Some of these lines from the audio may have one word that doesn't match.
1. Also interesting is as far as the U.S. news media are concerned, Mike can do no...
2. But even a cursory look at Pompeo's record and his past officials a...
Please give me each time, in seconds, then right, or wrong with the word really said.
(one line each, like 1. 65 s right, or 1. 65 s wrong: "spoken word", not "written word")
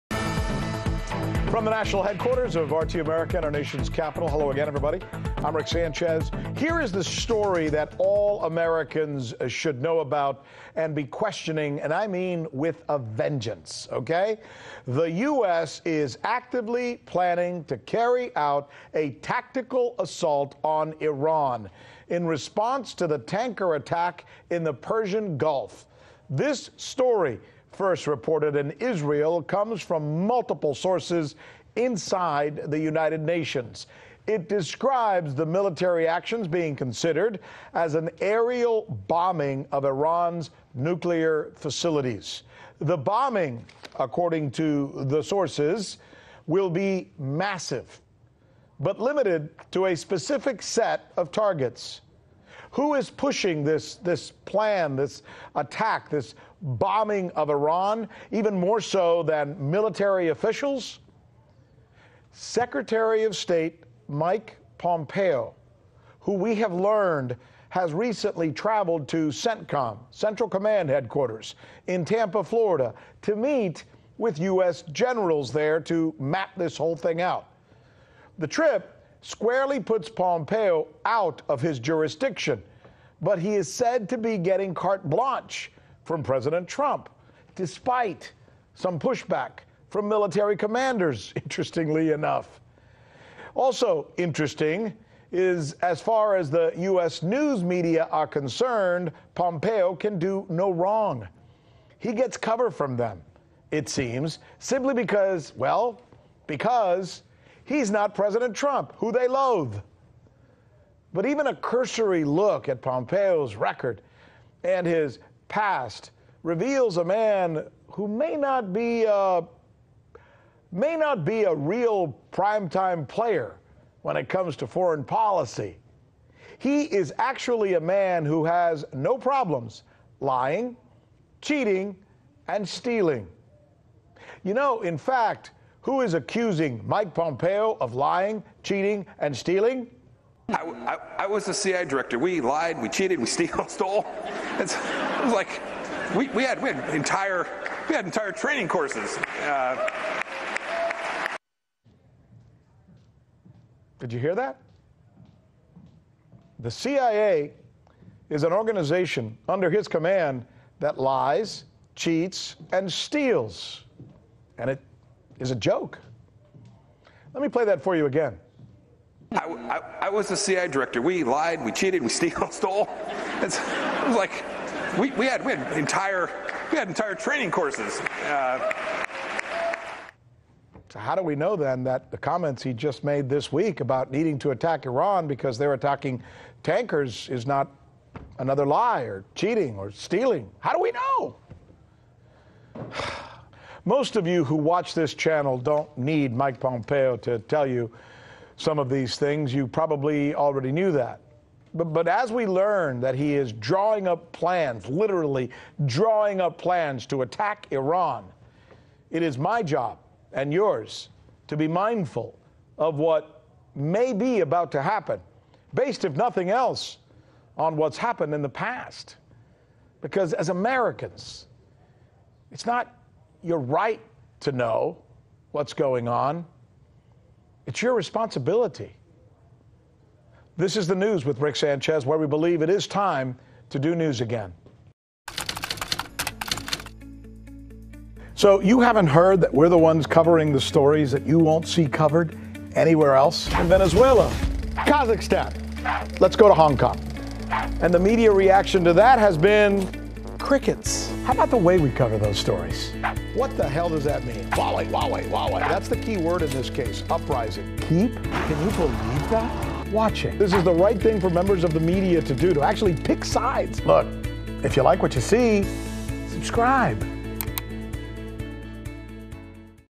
1. 93 s wrong: "Pompeo", not "Mike"
2. 111 s wrong: "reveals", not "officials".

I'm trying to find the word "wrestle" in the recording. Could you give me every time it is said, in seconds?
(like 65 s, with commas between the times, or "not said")
not said.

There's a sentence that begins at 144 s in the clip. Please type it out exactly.
It's, it was like we, we had we had entire we had entire training courses.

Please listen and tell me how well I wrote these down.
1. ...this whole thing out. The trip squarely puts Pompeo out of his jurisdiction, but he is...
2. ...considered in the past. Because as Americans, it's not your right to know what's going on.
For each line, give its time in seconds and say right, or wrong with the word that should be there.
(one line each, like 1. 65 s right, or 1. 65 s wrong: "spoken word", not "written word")
1. 76 s right
2. 217 s wrong: "happened", not "considered".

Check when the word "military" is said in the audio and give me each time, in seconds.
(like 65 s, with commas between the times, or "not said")
35 s, 59 s, 90 s.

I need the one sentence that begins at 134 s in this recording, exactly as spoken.
You know, in fact, who is accusing Mike Pompeo of lying, cheating, and stealing?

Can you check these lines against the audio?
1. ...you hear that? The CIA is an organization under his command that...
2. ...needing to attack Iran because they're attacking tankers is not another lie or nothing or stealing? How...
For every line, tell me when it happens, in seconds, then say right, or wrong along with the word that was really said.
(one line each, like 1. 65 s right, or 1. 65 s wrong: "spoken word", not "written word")
1. 154 s right
2. 184 s wrong: "cheating", not "nothing".